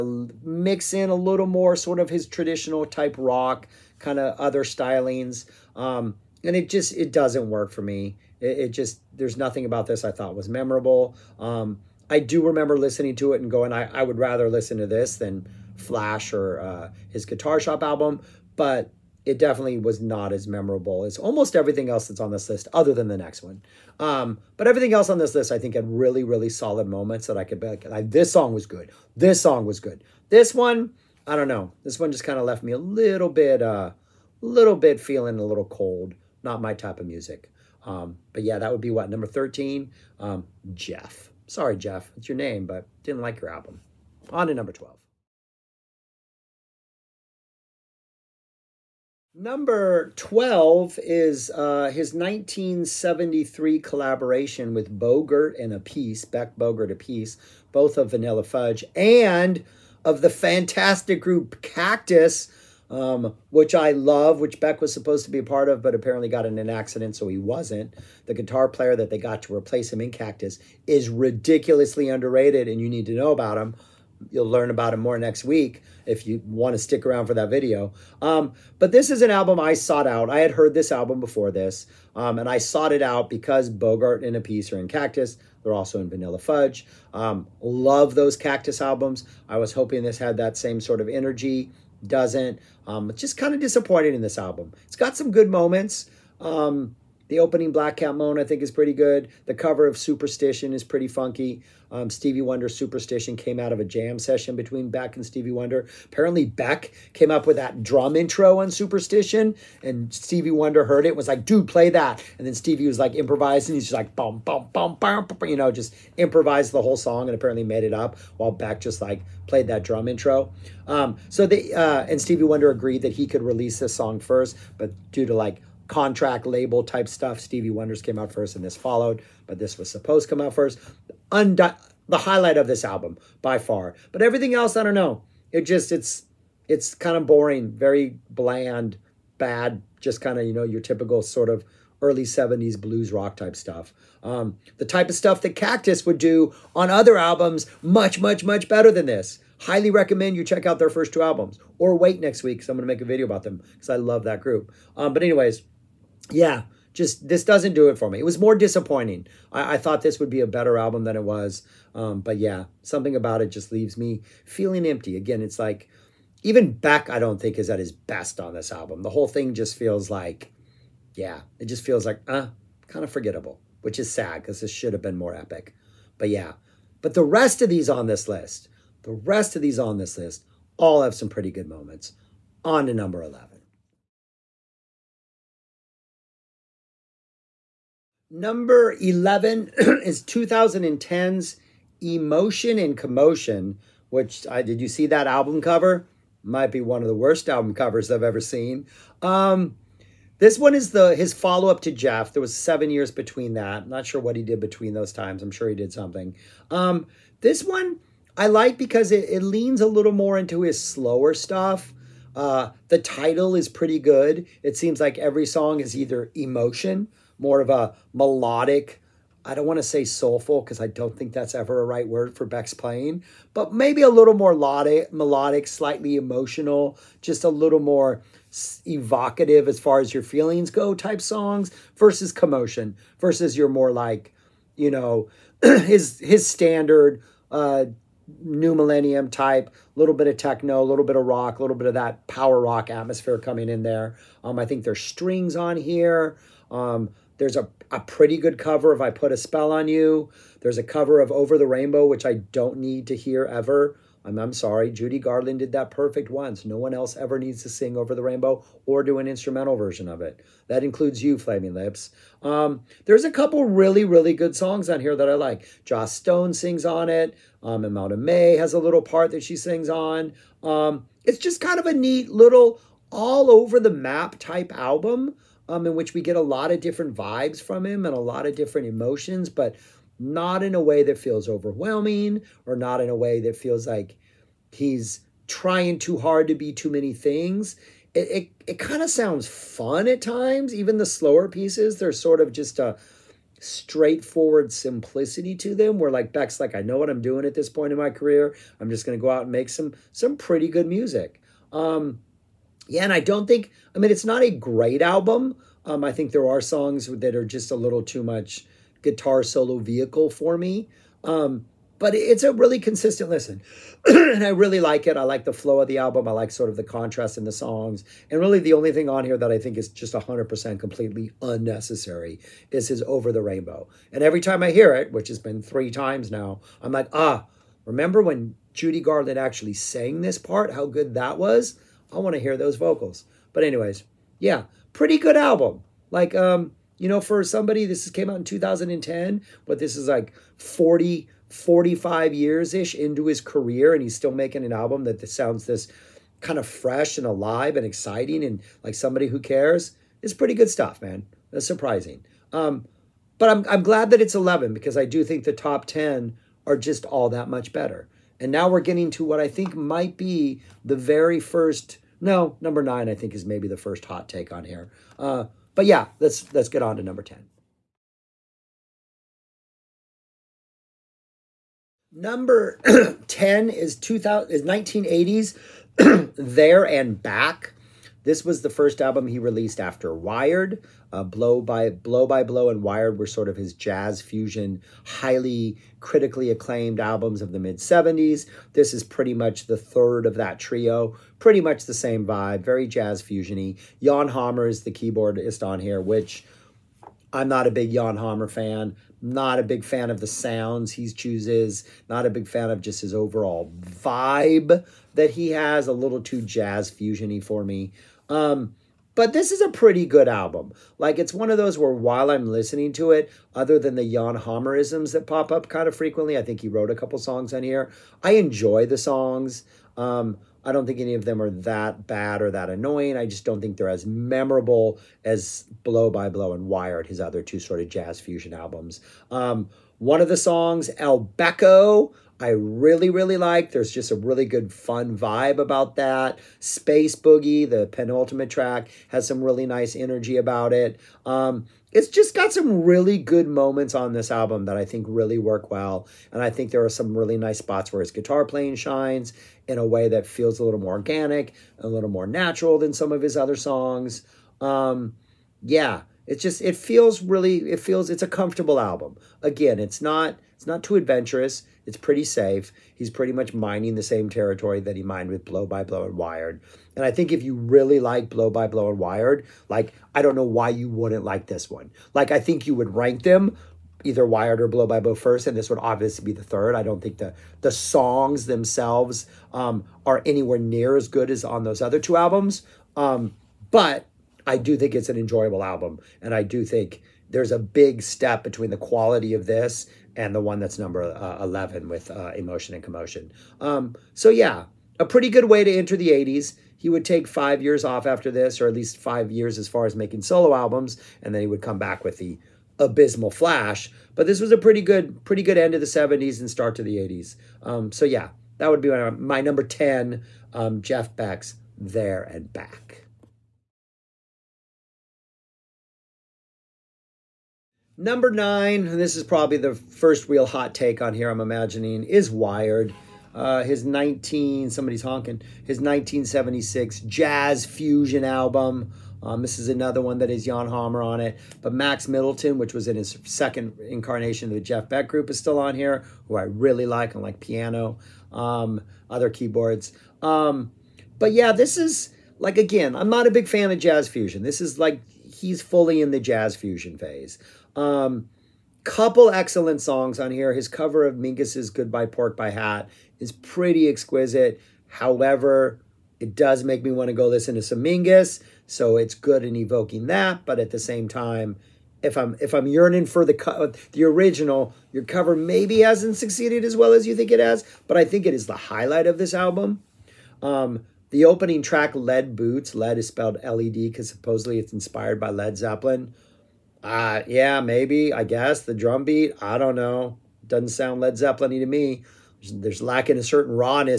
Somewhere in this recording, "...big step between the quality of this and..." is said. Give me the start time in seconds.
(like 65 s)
487 s.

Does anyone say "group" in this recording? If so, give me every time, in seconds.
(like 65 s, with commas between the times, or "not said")
61 s, 154 s, 535 s.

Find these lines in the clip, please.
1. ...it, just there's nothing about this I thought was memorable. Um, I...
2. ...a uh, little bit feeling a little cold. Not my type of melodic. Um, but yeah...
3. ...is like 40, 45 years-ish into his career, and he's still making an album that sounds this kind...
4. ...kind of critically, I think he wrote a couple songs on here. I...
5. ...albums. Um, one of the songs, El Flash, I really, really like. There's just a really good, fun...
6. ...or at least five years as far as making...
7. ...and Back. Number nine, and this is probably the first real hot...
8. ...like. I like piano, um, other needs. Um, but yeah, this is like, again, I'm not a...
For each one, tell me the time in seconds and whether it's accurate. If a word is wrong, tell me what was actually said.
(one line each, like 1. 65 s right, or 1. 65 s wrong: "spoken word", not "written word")
1. 8 s right
2. 33 s wrong: "music", not "melodic"
3. 339 s right
4. 415 s wrong: "frequently", not "critically"
5. 428 s wrong: "Becco", not "Flash"
6. 498 s right
7. 512 s right
8. 536 s wrong: "keyboards", not "needs".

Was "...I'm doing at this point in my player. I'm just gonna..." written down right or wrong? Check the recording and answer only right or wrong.
wrong.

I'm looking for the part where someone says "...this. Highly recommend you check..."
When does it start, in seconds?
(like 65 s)
149 s.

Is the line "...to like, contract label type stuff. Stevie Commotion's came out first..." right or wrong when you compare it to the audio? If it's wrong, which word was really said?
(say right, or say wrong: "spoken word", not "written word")
wrong: "Wonder", not "Commotion".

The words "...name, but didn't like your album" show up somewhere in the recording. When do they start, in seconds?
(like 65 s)
42 s.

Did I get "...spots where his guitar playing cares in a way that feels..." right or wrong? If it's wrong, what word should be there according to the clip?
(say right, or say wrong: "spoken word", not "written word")
wrong: "shines", not "cares".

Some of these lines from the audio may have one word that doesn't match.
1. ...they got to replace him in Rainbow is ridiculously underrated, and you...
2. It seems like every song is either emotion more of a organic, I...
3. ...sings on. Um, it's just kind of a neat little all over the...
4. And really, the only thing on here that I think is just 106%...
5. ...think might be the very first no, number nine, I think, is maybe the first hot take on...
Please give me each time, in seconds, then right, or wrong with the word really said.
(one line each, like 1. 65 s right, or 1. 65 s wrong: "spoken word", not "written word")
1. 69 s wrong: "Cactus", not "Rainbow"
2. 214 s wrong: "melodic", not "organic"
3. 269 s right
4. 318 s wrong: "100", not "106"
5. 359 s right.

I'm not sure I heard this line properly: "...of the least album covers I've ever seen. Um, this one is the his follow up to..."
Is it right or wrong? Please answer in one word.
wrong.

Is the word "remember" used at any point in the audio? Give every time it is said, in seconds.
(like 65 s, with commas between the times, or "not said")
12 s, 327 s.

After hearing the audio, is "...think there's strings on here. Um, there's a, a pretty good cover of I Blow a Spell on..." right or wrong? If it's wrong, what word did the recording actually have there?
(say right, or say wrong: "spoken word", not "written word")
wrong: "Put", not "Blow".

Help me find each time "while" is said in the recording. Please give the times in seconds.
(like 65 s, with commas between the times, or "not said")
118 s, 411 s.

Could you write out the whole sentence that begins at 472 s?
Like, I think you would rank them either Wired or Blow by Blow first, and this would obviously be the third.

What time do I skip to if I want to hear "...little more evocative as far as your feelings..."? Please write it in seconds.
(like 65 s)
227 s.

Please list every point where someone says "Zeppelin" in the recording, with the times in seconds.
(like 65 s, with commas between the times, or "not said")
575 s, 581 s.